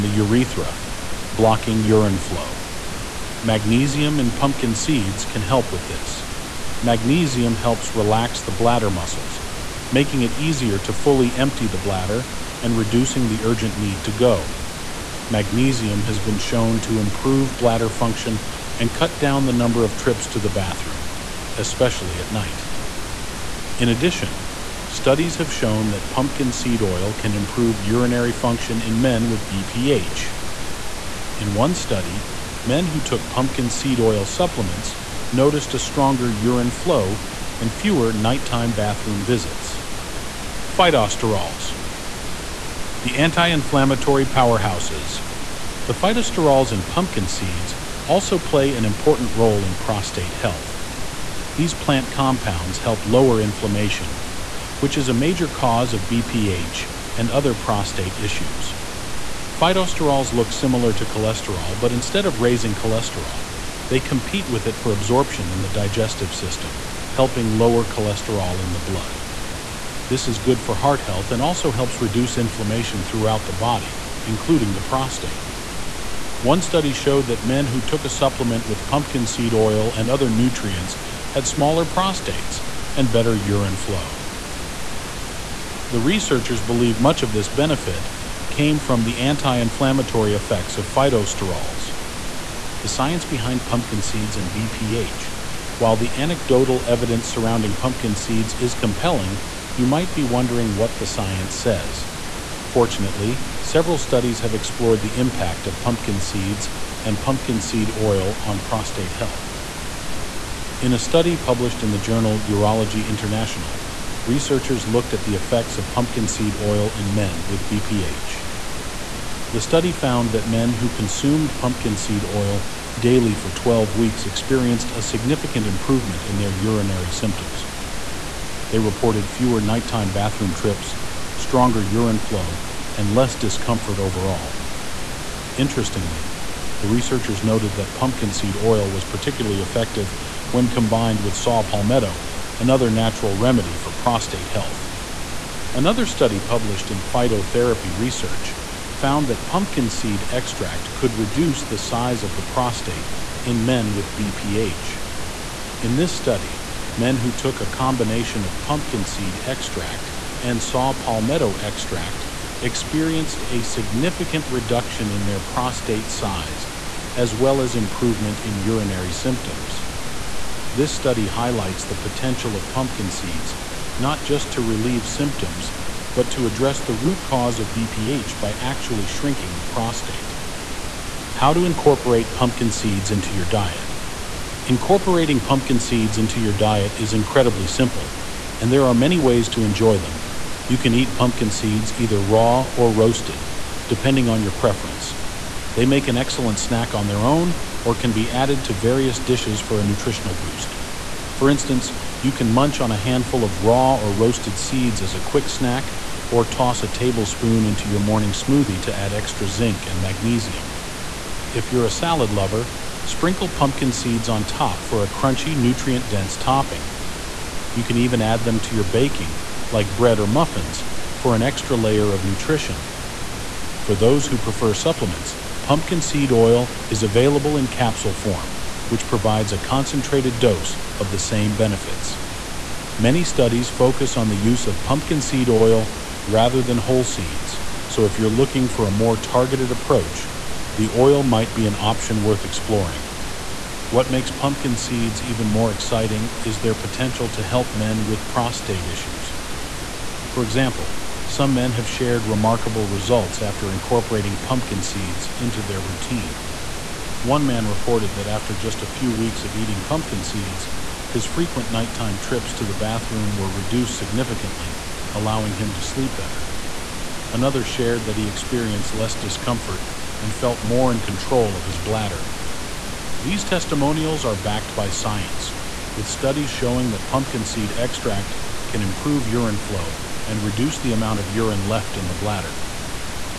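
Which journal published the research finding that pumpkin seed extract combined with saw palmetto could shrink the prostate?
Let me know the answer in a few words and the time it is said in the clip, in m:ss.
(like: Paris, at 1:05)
Phytotherapy Research, at 2:26.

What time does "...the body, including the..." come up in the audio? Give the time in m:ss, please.
1:13.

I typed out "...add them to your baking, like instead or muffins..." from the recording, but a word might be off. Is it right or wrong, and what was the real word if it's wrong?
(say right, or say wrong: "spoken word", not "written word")
wrong: "bread", not "instead".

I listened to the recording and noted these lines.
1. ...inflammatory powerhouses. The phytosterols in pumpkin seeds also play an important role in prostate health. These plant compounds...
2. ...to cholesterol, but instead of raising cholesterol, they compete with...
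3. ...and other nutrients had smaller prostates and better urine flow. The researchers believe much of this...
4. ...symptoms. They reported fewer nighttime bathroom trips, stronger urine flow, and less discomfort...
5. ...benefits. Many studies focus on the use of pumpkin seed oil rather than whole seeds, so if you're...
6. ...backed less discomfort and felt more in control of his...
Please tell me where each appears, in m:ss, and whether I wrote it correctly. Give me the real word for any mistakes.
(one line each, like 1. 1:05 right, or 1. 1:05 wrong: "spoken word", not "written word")
1. 0:43 right
2. 1:00 right
3. 1:19 right
4. 2:07 right
5. 3:51 right
6. 4:28 wrong: "experienced", not "backed".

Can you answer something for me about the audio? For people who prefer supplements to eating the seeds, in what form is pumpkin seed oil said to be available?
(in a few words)
capsule form.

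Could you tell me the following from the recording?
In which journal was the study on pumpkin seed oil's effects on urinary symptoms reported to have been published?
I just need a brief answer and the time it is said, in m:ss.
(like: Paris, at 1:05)
Urology International, at 1:52.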